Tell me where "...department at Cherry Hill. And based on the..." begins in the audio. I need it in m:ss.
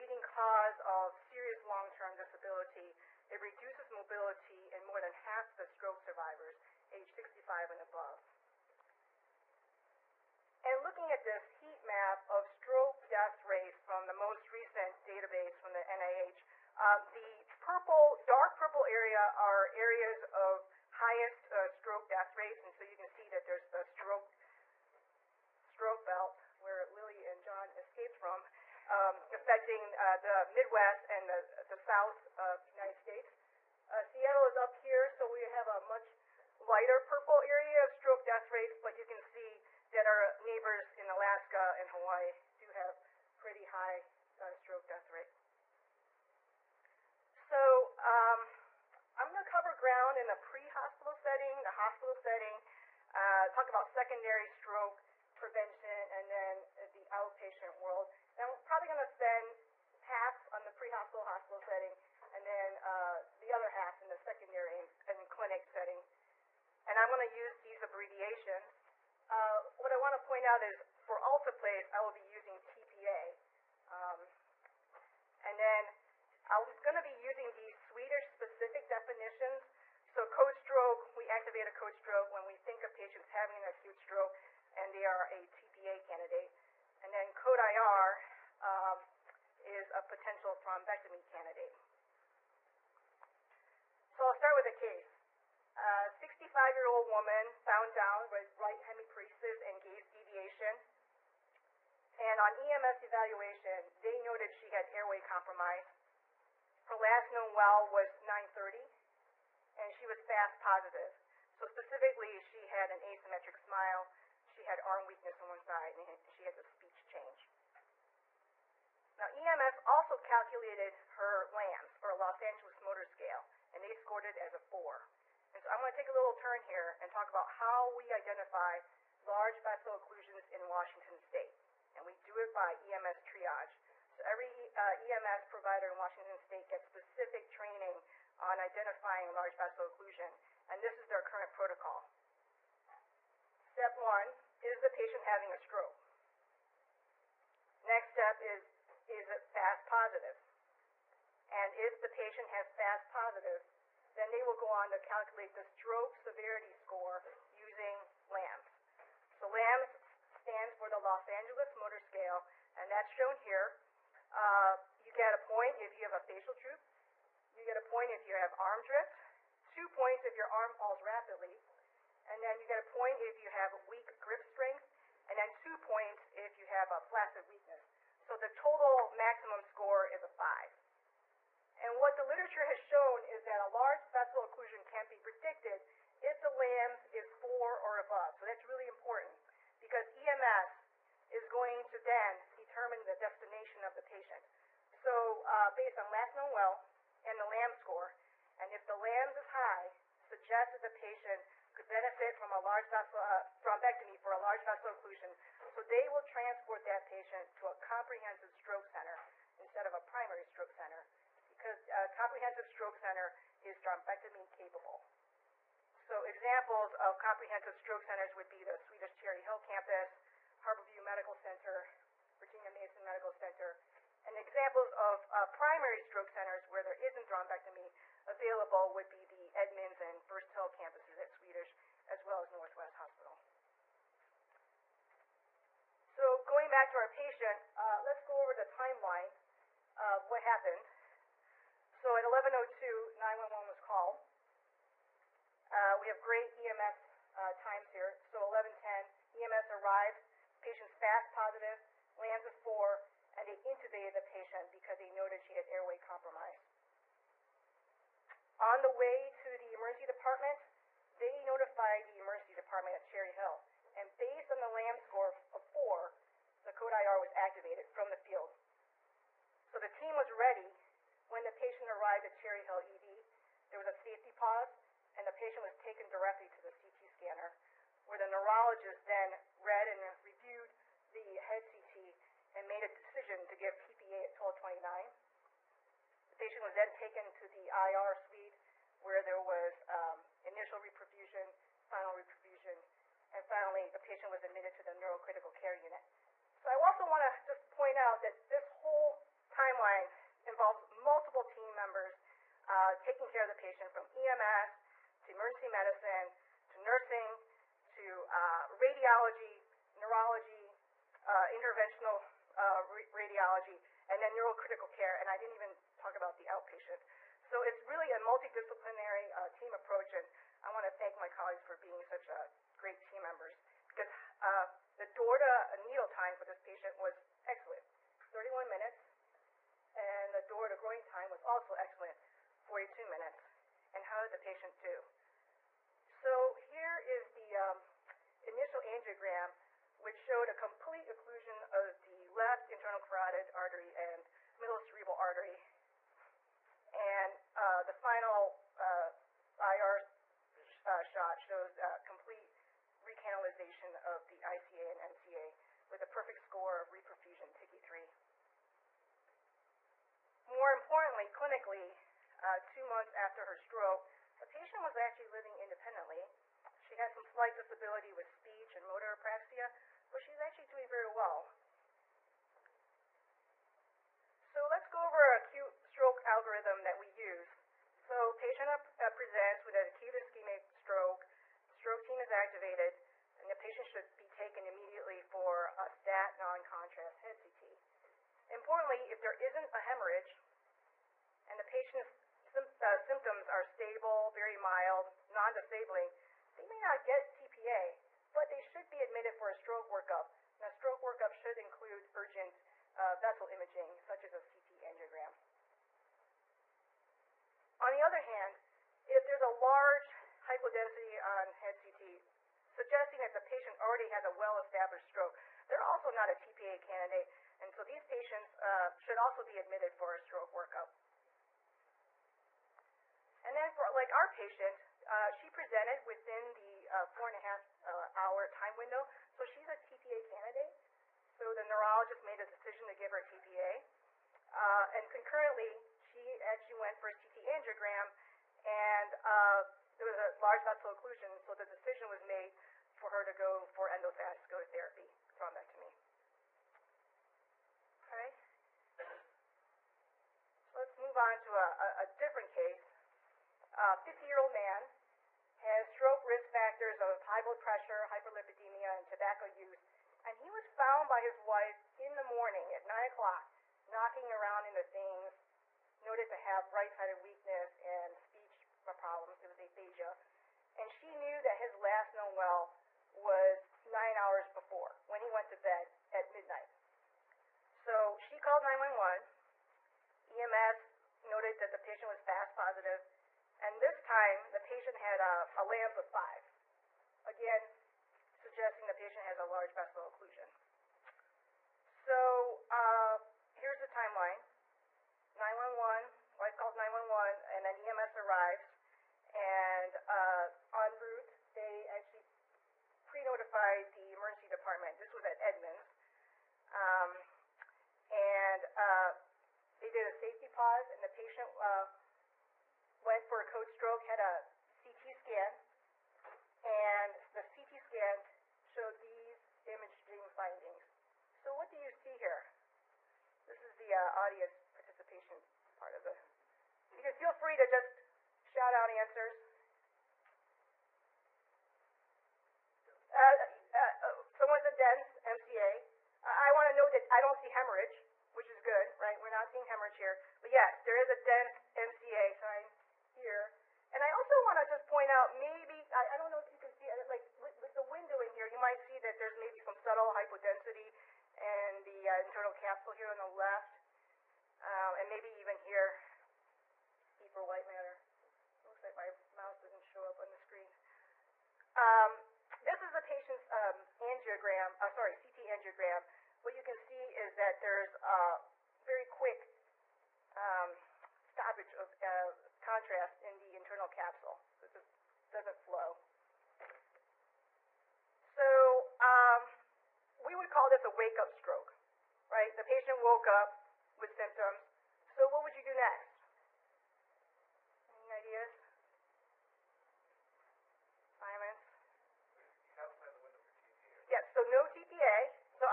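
4:22.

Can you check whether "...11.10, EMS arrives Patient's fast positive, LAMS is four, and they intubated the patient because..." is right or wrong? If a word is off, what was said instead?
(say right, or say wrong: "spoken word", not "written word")
right.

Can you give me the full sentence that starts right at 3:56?
So going back to our patient, uh, let's go over the timeline of what happened.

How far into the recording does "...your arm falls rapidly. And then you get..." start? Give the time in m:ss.
2:50.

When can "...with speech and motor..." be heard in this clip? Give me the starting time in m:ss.
6:08.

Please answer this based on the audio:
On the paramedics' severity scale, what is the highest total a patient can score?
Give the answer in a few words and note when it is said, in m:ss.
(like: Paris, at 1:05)
5, at 2:59.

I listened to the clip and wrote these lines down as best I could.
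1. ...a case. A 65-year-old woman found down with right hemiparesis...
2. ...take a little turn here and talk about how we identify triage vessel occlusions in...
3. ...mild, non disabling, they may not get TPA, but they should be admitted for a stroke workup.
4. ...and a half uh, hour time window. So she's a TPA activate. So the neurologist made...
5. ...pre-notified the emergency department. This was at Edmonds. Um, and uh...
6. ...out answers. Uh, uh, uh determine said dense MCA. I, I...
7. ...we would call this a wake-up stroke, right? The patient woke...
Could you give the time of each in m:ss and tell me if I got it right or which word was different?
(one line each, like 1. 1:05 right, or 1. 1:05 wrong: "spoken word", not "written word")
1. 1:34 right
2. 2:05 wrong: "large", not "triage"
3. 6:34 right
4. 7:07 wrong: "candidate", not "activate"
5. 8:23 right
6. 8:48 wrong: "someone", not "determine"
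7. 9:40 right.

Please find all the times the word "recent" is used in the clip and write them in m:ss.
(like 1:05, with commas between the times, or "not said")
0:14.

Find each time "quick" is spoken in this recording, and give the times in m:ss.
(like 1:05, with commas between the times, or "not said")
9:29.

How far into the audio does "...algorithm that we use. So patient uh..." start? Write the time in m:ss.
6:16.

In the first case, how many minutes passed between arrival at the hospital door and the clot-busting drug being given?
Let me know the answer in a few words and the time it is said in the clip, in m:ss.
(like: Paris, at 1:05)
31 minutes, at 5:28.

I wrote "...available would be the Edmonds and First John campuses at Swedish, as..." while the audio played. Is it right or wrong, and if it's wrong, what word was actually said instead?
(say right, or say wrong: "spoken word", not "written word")
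wrong: "Hill", not "John".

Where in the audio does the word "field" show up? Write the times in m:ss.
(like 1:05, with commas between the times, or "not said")
4:28.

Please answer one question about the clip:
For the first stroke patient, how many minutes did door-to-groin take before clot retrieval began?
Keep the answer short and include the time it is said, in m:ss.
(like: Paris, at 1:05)
42 minutes, at 5:32.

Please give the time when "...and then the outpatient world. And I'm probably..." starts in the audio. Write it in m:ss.
0:56.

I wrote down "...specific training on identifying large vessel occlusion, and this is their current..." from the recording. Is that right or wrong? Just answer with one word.
right.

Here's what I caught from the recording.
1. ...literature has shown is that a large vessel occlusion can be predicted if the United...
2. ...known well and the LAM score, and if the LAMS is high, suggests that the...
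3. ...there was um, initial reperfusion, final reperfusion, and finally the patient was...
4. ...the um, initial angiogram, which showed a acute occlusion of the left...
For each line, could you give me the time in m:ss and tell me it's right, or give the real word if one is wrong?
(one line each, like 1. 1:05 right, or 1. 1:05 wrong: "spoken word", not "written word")
1. 3:02 wrong: "LAMS", not "United"
2. 3:16 right
3. 4:49 right
4. 5:37 wrong: "complete", not "acute".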